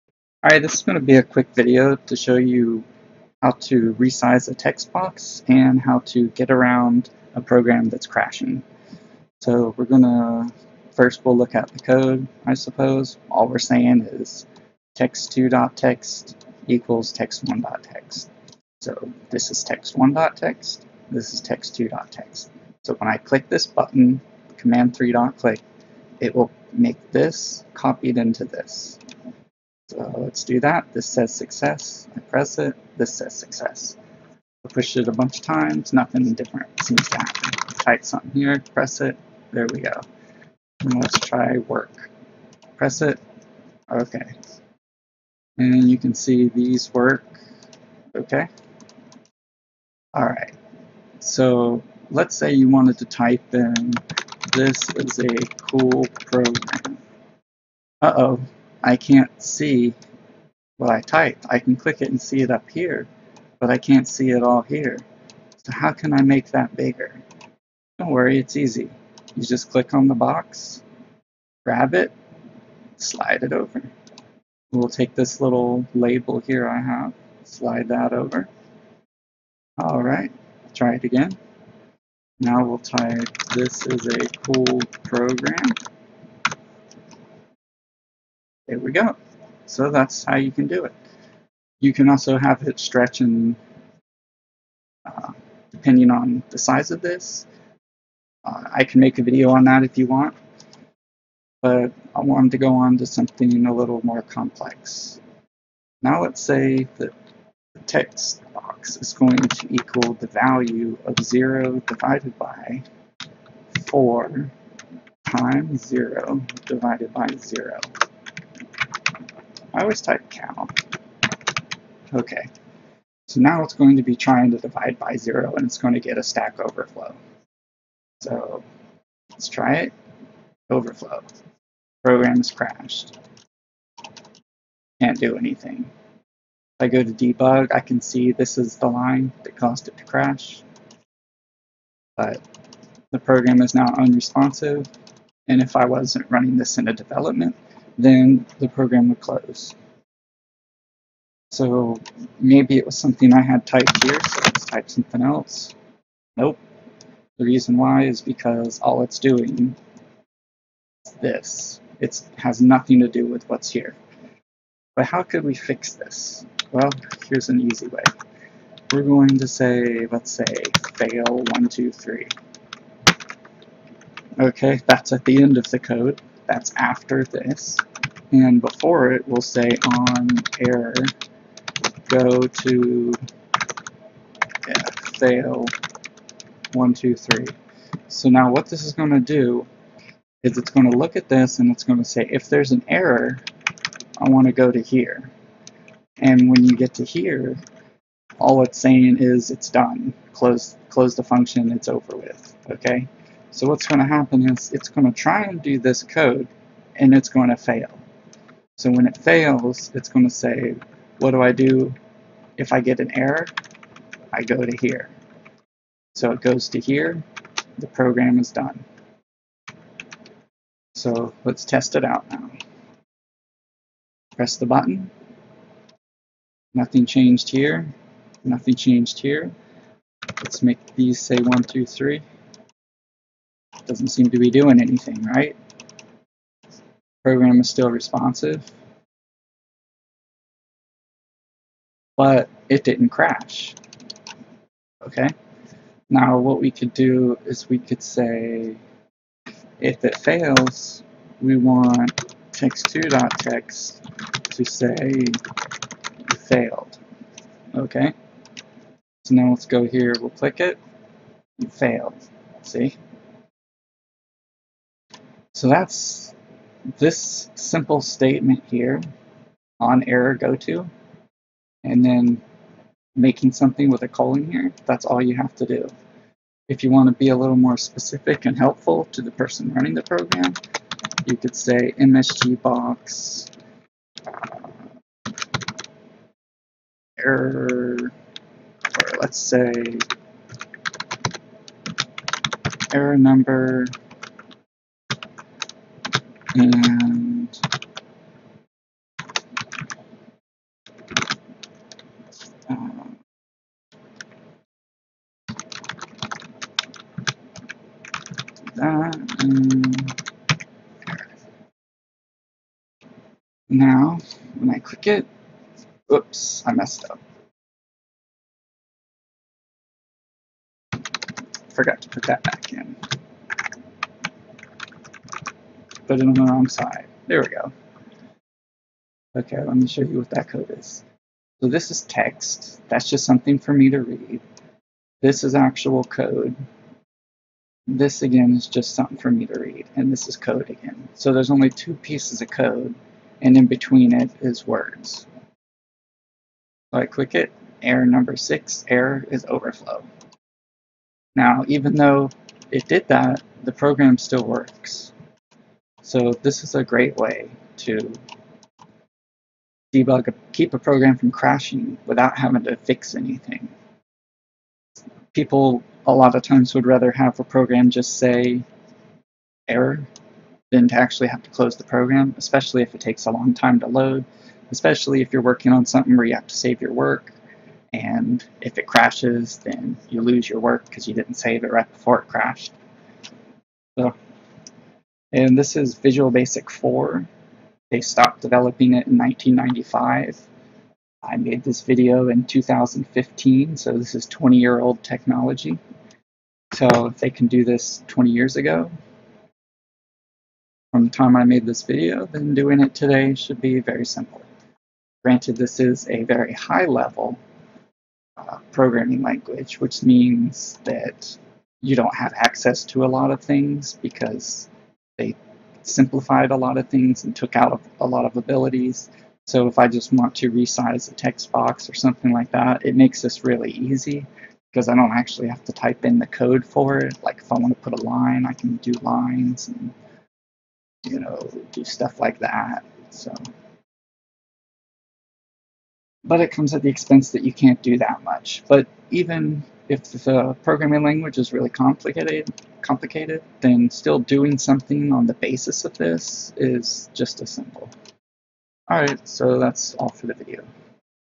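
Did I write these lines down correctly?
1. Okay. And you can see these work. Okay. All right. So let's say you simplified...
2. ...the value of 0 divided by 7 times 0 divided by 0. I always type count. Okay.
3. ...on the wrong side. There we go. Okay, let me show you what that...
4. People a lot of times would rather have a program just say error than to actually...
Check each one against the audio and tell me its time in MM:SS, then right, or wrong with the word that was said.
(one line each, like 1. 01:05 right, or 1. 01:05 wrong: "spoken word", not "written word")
1. 00:43 wrong: "wanted", not "simplified"
2. 01:50 wrong: "4", not "7"
3. 05:26 right
4. 06:05 right.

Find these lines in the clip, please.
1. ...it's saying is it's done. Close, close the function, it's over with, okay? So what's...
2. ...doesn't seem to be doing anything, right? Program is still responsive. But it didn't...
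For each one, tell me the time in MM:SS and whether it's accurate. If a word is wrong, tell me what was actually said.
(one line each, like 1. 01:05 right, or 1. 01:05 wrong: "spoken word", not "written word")
1. 03:18 right
2. 03:53 right.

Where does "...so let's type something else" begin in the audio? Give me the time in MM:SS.
02:34.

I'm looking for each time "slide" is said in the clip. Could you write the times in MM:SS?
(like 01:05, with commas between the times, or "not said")
01:12, 01:17.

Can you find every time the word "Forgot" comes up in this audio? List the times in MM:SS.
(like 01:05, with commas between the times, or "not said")
05:21.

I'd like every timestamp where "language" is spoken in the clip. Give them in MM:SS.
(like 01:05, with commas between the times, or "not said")
06:49, 07:21.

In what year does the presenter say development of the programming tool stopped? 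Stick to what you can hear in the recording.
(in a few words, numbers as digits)
1995.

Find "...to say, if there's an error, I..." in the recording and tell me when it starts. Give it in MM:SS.
03:11.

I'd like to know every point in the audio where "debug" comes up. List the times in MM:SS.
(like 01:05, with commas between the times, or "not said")
02:17, 05:59.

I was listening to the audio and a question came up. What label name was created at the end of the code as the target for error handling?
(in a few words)
fail123.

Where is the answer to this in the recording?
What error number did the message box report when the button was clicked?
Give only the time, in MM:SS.
05:48.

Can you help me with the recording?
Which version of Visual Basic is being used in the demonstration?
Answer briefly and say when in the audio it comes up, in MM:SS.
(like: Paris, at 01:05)
Visual Basic 4, at 06:25.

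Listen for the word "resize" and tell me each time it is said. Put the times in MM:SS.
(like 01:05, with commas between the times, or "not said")
00:03, 07:00.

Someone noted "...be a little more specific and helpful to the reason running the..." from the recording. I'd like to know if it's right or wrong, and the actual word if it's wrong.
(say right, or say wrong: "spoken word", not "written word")
wrong: "person", not "reason".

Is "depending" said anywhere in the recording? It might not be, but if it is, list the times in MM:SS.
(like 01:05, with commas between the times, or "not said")
01:35.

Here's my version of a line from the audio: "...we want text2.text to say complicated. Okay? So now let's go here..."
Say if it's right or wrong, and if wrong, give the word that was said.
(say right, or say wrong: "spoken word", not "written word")
wrong: "failed", not "complicated".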